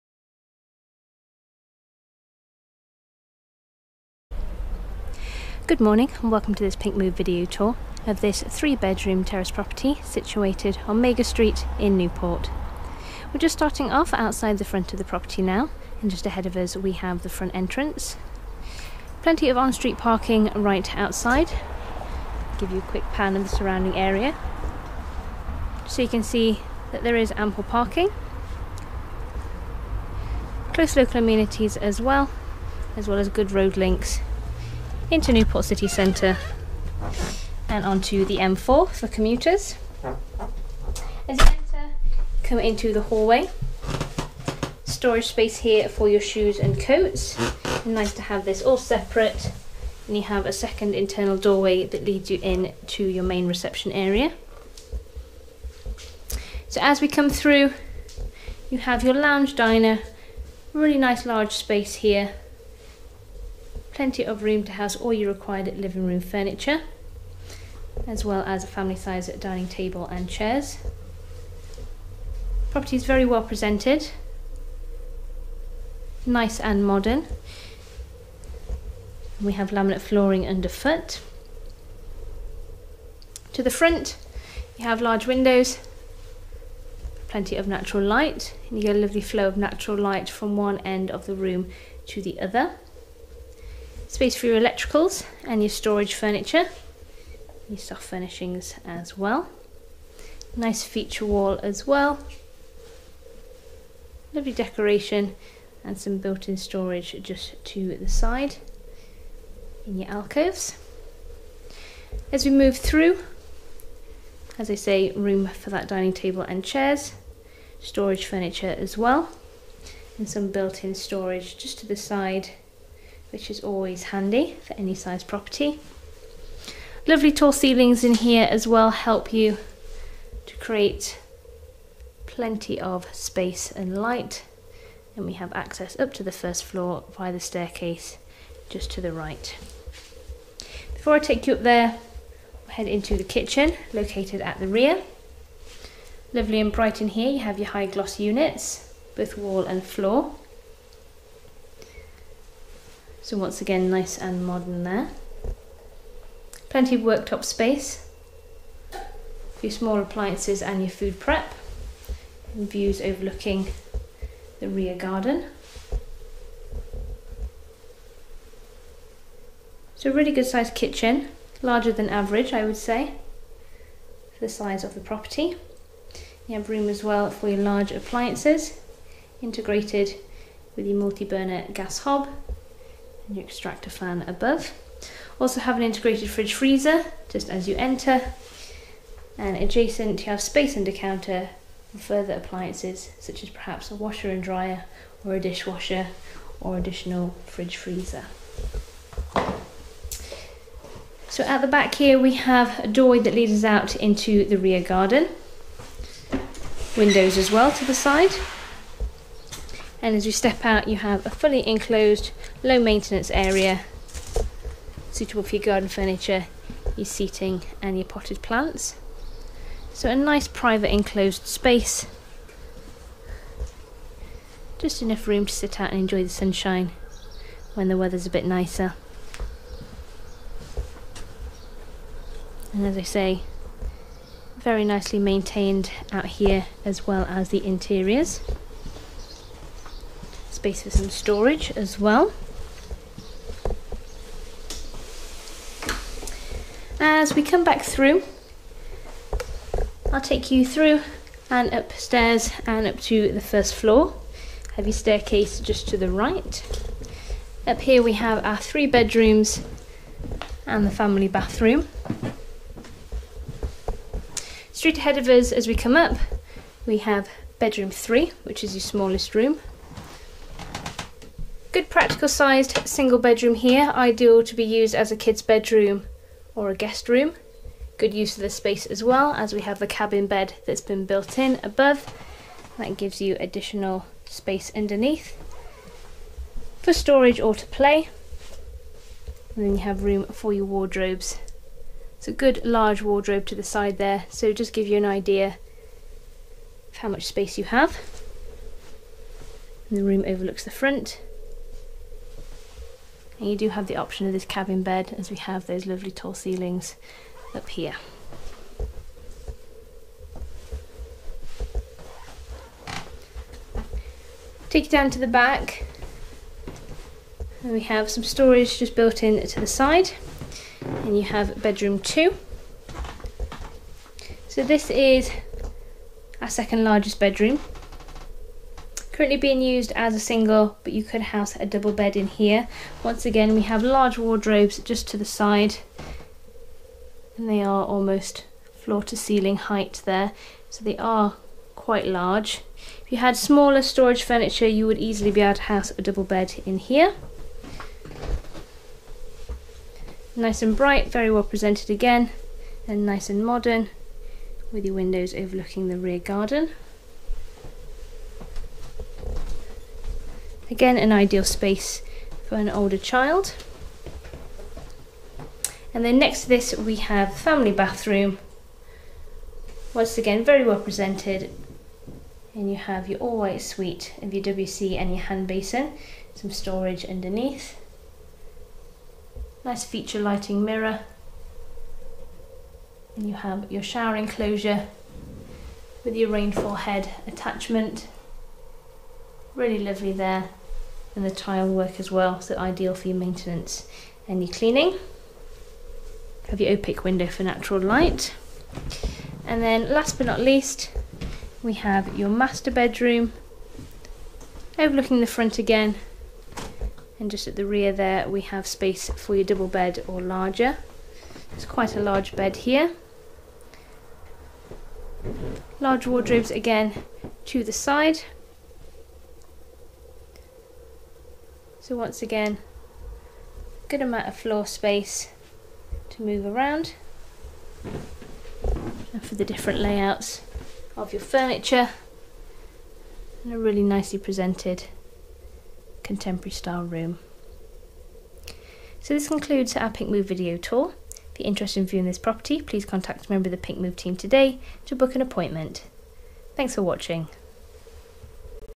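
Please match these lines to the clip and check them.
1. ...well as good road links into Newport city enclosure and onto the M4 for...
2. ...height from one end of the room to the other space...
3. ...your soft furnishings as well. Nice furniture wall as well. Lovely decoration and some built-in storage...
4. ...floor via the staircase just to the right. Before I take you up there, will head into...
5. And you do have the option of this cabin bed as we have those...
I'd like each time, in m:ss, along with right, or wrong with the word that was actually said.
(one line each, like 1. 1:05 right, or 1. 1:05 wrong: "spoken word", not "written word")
1. 0:33 wrong: "centre", not "enclosure"
2. 1:29 wrong: "light", not "height"
3. 1:37 wrong: "feature", not "furniture"
4. 2:16 right
5. 5:03 right.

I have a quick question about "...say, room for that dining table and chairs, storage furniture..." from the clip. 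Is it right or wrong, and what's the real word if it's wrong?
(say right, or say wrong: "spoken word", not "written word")
right.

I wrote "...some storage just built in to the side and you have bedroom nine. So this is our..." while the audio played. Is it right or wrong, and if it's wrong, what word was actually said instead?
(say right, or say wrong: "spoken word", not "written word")
wrong: "two", not "nine".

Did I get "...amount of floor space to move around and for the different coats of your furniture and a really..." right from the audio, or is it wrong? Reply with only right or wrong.
wrong.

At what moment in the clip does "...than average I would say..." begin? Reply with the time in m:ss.
2:51.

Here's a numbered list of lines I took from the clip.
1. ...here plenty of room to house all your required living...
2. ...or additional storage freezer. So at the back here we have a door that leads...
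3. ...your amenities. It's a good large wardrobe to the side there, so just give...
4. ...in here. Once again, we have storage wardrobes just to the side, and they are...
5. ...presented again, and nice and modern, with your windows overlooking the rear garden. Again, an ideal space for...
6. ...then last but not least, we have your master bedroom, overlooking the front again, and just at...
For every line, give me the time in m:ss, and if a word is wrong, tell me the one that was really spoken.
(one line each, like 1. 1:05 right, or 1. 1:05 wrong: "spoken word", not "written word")
1. 1:01 right
2. 3:16 wrong: "fridge", not "storage"
3. 4:50 wrong: "wardrobes", not "amenities"
4. 5:32 wrong: "large", not "storage"
5. 5:51 right
6. 6:39 right.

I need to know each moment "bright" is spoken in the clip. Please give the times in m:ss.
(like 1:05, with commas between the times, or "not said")
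2:26, 5:50.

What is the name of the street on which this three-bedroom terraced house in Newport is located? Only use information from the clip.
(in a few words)
Magor Street.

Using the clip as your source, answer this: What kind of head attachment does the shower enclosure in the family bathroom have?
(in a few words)
Rainfall head.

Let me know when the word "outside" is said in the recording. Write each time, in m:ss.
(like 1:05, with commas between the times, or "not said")
0:14, 0:20.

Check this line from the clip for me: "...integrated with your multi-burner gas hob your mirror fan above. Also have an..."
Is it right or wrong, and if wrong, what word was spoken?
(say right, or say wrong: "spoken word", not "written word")
wrong: "extractor", not "mirror".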